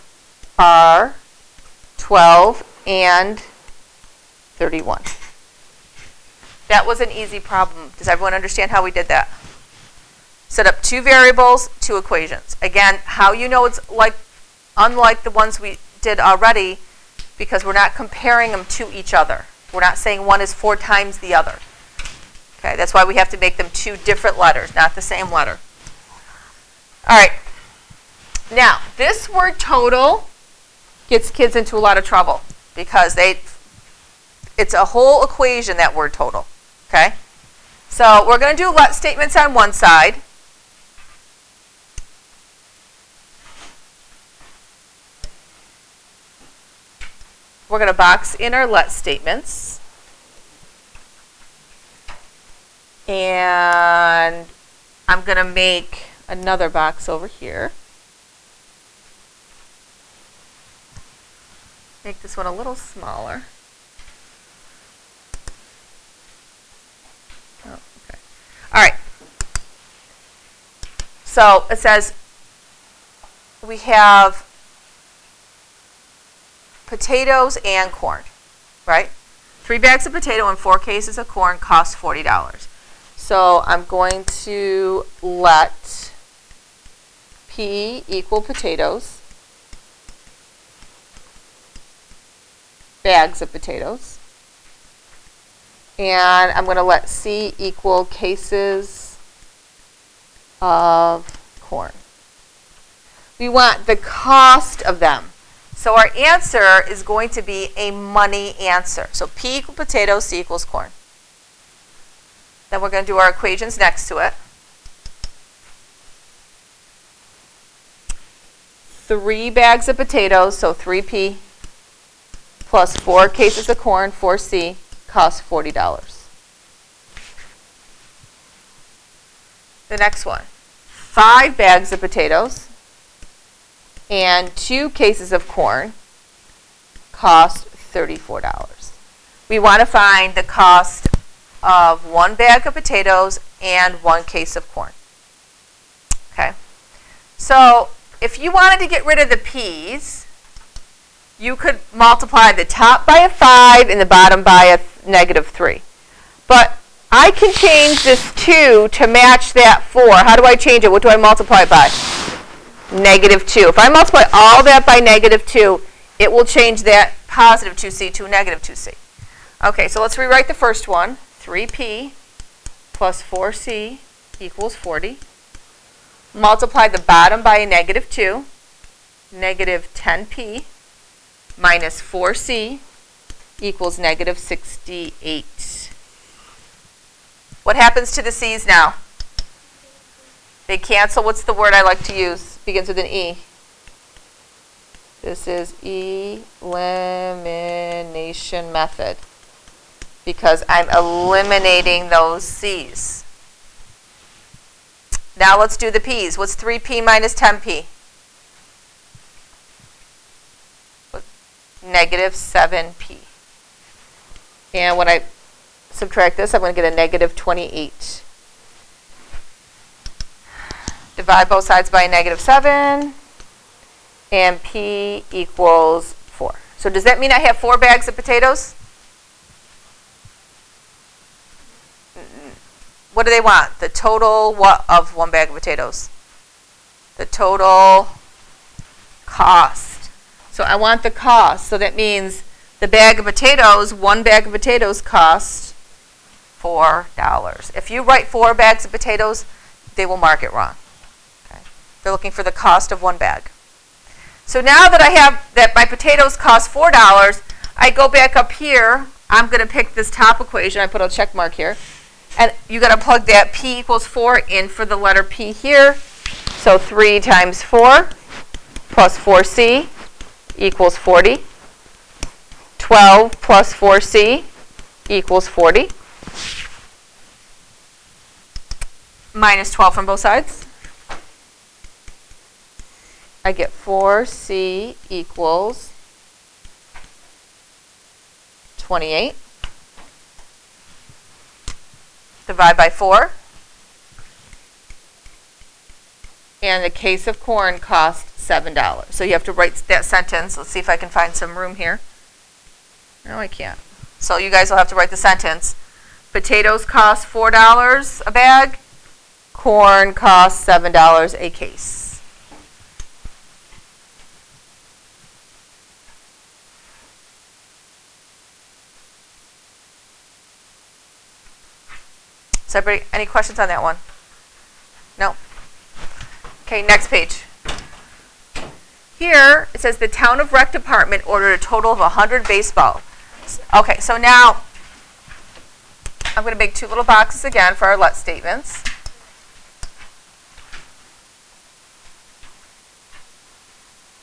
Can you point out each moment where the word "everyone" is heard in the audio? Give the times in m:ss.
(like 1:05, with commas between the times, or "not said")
0:08.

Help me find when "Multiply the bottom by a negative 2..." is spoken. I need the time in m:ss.
2:56.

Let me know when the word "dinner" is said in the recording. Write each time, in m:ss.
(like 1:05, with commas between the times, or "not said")
not said.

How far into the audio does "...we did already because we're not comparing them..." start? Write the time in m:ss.
0:15.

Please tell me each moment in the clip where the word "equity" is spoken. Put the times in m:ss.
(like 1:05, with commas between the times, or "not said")
not said.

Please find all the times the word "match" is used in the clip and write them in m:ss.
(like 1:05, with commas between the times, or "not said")
2:39.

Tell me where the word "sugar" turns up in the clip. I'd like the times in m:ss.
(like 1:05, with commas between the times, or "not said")
not said.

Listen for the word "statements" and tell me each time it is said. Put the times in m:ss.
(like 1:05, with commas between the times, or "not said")
0:38, 0:48, 5:38.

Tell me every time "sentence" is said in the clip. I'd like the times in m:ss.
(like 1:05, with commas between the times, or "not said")
5:00, 5:05.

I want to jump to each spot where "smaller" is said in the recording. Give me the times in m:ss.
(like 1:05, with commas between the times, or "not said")
1:02.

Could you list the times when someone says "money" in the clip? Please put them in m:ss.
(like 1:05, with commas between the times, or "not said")
1:47.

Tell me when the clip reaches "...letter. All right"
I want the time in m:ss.
0:25.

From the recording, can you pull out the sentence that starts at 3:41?
Divide both sides by a negative 7, and p equals 4.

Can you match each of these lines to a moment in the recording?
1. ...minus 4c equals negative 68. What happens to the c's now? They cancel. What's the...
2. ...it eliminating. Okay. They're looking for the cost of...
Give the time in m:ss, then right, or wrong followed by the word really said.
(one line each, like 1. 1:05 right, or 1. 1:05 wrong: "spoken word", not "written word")
1. 3:01 right
2. 4:10 wrong: "wrong", not "eliminating".